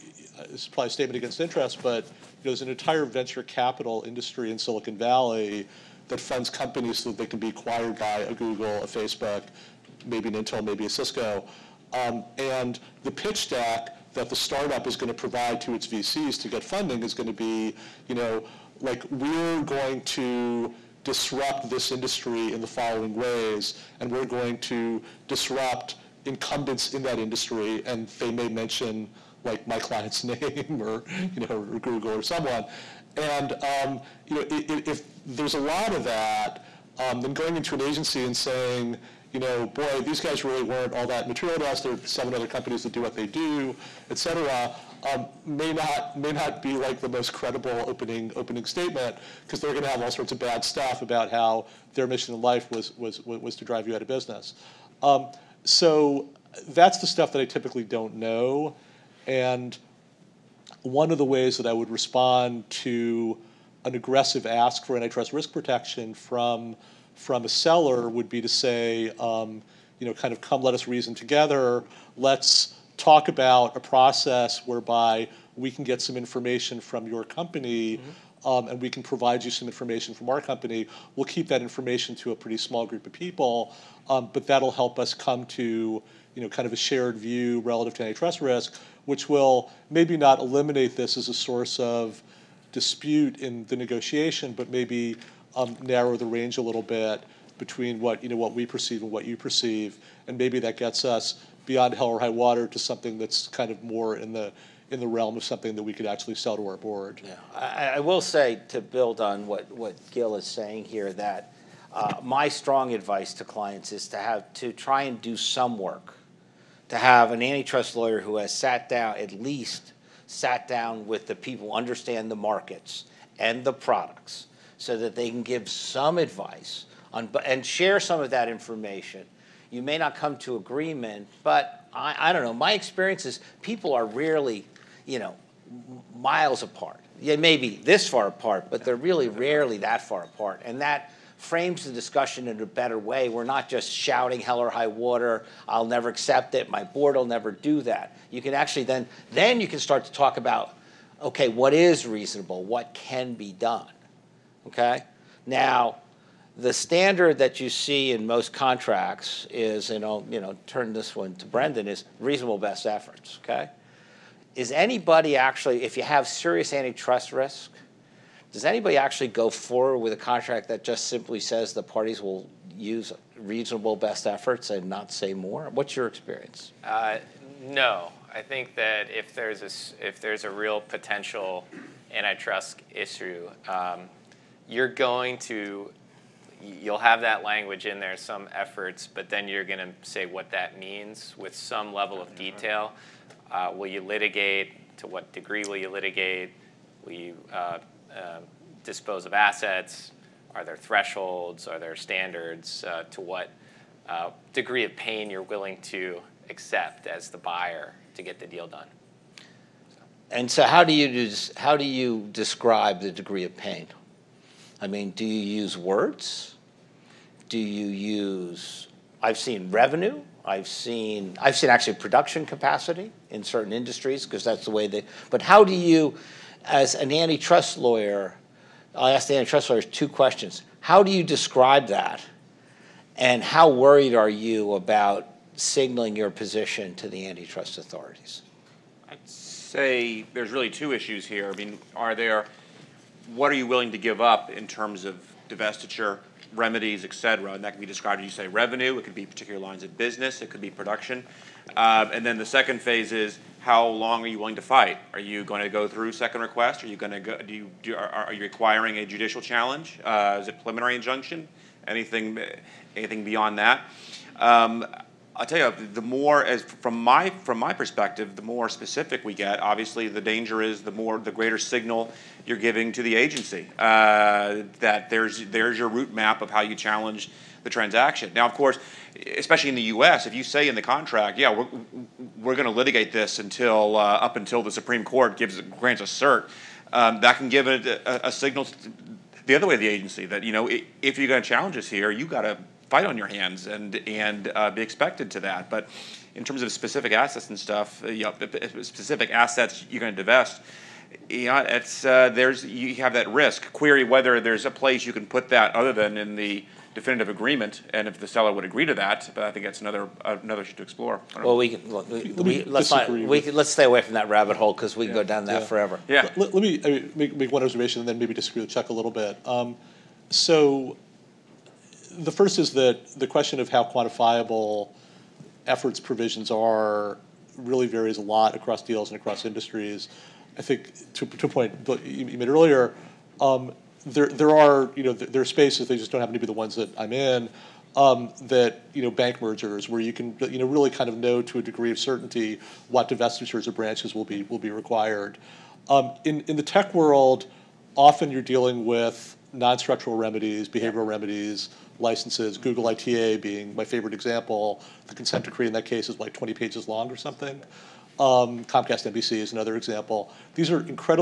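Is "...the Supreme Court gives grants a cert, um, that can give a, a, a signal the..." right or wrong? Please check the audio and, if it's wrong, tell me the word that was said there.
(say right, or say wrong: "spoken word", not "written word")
right.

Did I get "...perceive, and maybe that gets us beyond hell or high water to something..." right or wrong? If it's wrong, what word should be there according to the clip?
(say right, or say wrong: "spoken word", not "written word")
right.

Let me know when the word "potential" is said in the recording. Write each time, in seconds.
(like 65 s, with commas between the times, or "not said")
180 s.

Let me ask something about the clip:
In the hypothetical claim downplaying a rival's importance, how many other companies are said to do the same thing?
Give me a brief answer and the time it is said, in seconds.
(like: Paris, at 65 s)
7, at 42 s.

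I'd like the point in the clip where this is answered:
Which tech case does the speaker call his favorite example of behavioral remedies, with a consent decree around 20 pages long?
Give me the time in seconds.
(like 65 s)
352 s.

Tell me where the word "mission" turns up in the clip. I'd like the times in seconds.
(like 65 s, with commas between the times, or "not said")
52 s.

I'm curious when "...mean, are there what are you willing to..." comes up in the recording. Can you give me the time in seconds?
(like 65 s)
241 s.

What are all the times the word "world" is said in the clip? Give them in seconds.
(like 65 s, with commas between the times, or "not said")
346 s.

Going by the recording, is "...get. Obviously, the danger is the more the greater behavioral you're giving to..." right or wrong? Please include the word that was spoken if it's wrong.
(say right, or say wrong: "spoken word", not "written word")
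wrong: "signal", not "behavioral".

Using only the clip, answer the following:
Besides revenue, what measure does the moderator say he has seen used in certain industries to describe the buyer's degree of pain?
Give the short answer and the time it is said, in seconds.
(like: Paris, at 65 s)
Production capacity, at 221 s.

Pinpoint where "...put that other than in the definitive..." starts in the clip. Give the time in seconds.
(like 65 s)
305 s.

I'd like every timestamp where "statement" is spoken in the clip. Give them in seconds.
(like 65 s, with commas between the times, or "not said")
0 s, 48 s.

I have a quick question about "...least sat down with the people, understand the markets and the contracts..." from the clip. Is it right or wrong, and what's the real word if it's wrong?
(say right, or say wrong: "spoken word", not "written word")
wrong: "products", not "contracts".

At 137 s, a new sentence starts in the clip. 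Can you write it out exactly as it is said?
Yeah, maybe this far apart, but they're really rarely that far apart.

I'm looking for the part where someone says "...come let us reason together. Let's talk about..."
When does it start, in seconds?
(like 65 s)
70 s.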